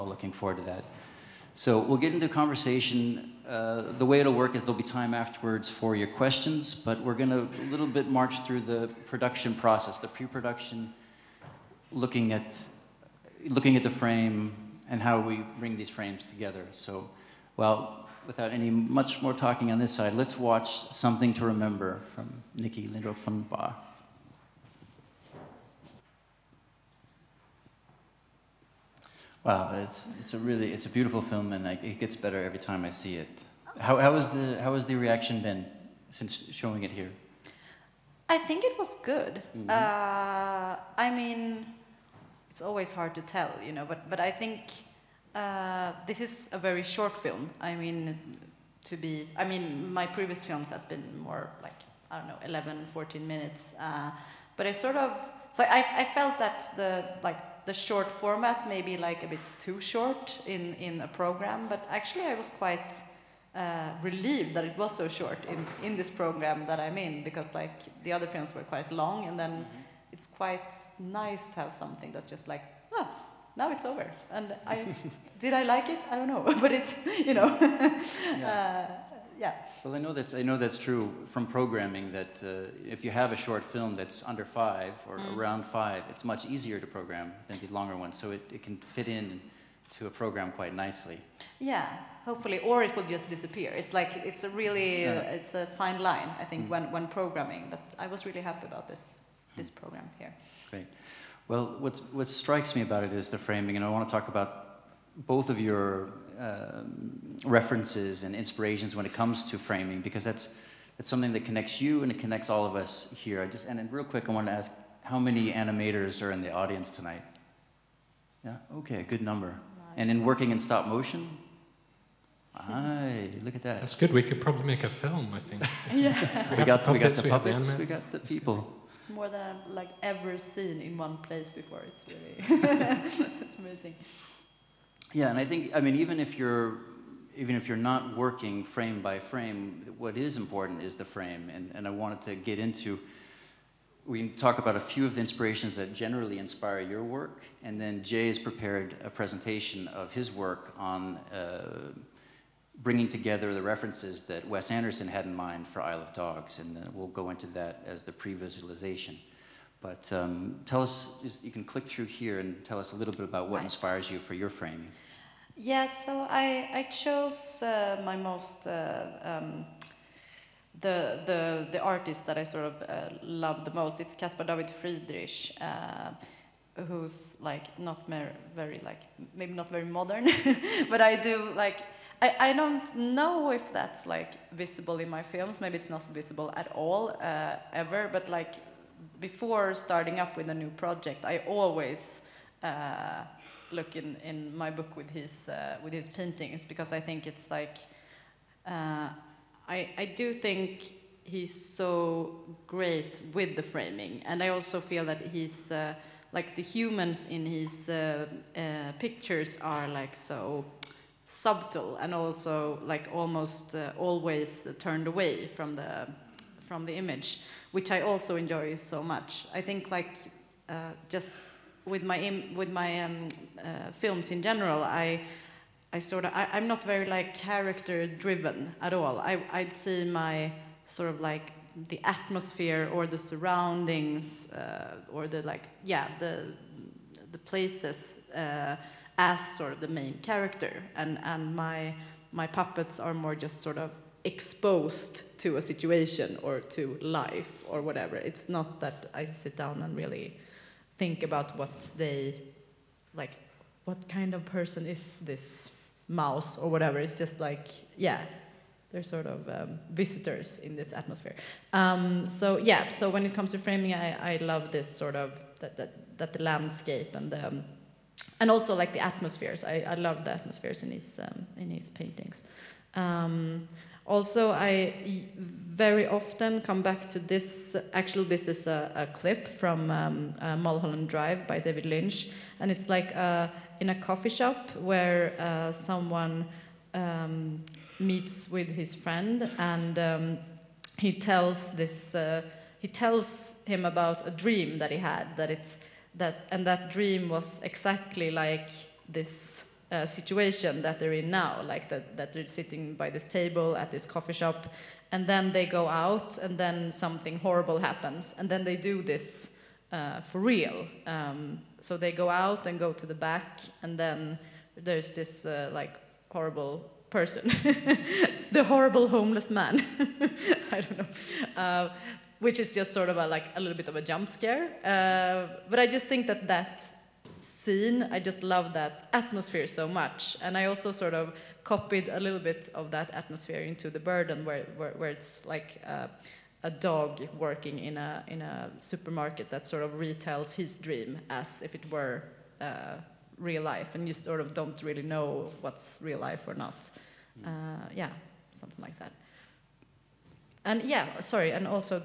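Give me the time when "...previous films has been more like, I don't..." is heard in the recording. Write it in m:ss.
0:50.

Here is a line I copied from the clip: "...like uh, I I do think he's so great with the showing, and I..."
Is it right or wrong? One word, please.
wrong.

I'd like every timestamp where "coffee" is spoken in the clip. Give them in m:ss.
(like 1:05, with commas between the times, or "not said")
4:43, 5:04.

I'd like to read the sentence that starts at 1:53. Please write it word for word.
I just and then real quick, I want to ask how many animators are in the audience tonight?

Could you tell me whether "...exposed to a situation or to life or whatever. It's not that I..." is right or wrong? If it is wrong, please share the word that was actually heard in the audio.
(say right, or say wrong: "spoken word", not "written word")
right.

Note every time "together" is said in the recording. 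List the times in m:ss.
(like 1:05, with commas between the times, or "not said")
0:16, 2:33.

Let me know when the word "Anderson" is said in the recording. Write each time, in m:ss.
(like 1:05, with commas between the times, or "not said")
2:34.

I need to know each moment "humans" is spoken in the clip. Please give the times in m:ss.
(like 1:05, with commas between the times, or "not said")
3:26.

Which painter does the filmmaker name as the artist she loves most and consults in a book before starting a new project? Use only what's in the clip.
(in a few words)
Caspar David Friedrich.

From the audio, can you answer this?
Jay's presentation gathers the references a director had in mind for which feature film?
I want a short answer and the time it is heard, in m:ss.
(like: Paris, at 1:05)
Isle of Dogs, at 2:35.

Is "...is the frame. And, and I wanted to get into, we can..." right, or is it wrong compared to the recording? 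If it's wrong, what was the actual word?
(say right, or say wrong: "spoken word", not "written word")
right.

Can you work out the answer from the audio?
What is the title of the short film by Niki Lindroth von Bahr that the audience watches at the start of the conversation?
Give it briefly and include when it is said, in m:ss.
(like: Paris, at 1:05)
Something to Remember, at 0:20.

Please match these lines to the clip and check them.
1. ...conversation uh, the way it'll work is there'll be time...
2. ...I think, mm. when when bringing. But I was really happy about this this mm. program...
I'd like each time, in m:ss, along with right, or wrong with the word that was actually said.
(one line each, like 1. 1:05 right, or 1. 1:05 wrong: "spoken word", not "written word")
1. 0:02 right
2. 1:36 wrong: "programming", not "bringing".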